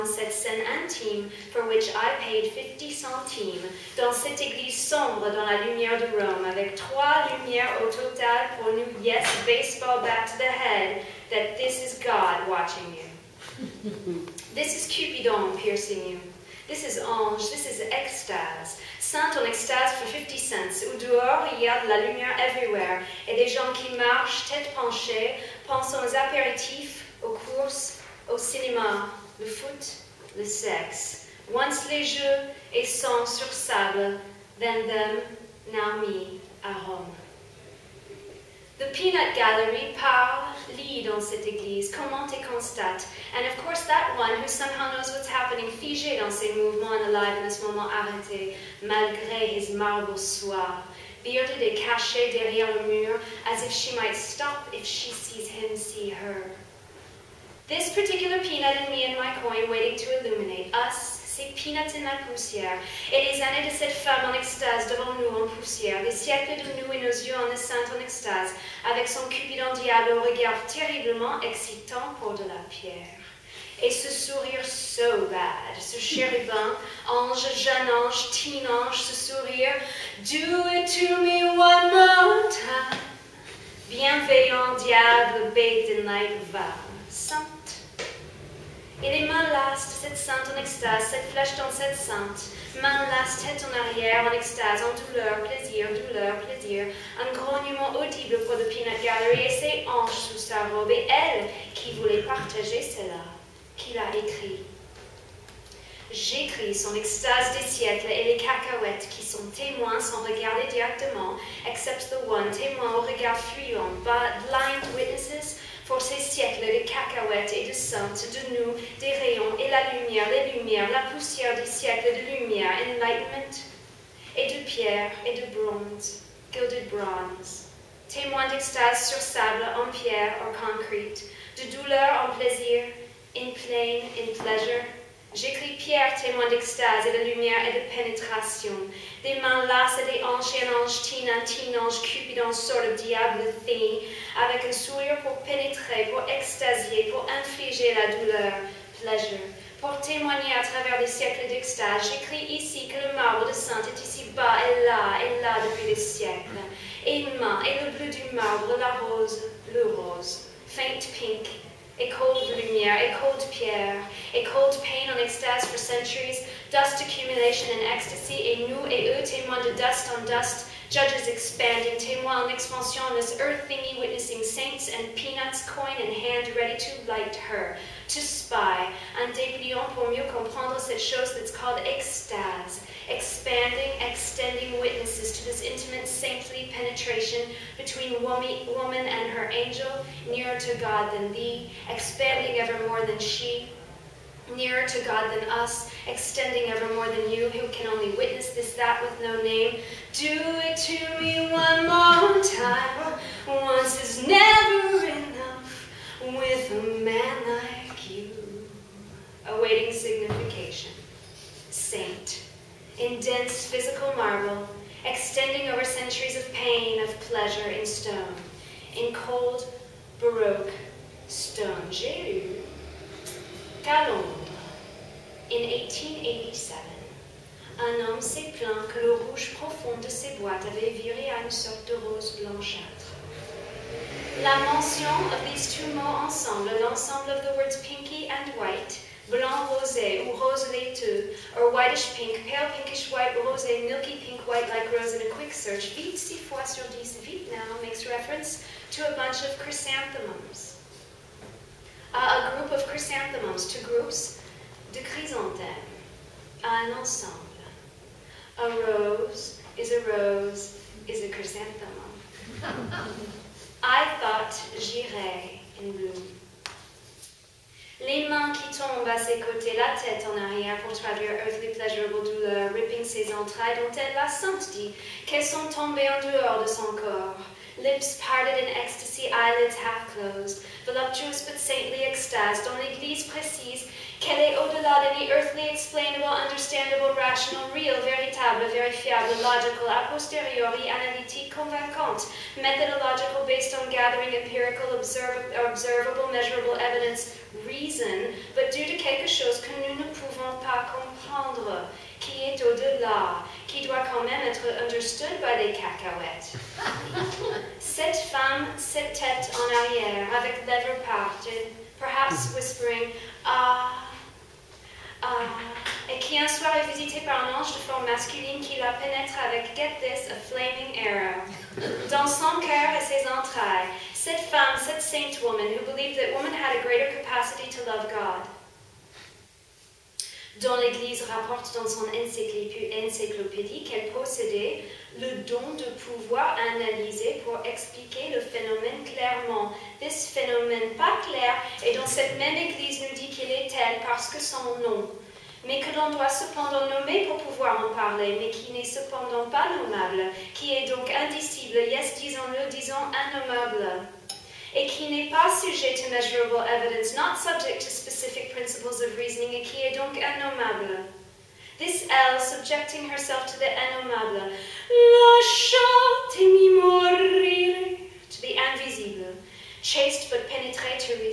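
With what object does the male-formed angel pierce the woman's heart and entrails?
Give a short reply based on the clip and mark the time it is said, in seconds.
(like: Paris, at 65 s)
a flaming arrow, at 320 s.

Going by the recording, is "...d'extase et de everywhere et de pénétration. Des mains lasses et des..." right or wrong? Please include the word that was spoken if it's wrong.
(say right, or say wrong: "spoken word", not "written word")
wrong: "lumière", not "everywhere".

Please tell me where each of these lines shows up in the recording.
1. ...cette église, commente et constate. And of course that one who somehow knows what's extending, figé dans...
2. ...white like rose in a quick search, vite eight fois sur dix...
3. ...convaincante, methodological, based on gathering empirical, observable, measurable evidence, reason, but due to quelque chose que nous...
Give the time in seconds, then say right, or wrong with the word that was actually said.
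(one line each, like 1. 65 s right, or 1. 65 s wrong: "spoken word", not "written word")
1. 41 s wrong: "happening", not "extending"
2. 244 s wrong: "six", not "eight"
3. 291 s right.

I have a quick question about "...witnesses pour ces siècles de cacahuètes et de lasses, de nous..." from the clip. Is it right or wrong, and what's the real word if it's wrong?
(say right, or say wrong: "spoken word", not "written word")
wrong: "saintes", not "lasses".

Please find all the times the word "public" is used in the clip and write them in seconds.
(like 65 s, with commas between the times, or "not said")
not said.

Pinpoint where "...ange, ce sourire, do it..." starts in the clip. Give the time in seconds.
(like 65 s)
78 s.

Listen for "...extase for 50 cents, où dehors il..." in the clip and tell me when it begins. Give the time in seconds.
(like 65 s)
19 s.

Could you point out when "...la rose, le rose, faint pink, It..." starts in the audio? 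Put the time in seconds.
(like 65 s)
158 s.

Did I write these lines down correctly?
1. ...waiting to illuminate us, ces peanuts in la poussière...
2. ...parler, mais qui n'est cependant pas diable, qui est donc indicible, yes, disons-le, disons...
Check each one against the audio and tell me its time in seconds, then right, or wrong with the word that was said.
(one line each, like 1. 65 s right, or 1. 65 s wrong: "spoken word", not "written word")
1. 59 s right
2. 347 s wrong: "nommable", not "diable".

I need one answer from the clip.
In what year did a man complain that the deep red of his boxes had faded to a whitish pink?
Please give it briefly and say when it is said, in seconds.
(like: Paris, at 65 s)
1887, at 225 s.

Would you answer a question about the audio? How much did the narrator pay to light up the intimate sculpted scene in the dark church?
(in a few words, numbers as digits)
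50 centimes.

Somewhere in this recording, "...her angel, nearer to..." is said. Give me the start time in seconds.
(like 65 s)
189 s.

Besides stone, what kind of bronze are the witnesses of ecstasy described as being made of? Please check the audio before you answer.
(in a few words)
gilded bronze.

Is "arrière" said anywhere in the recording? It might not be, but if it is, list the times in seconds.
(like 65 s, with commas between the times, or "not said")
93 s, 270 s, 309 s.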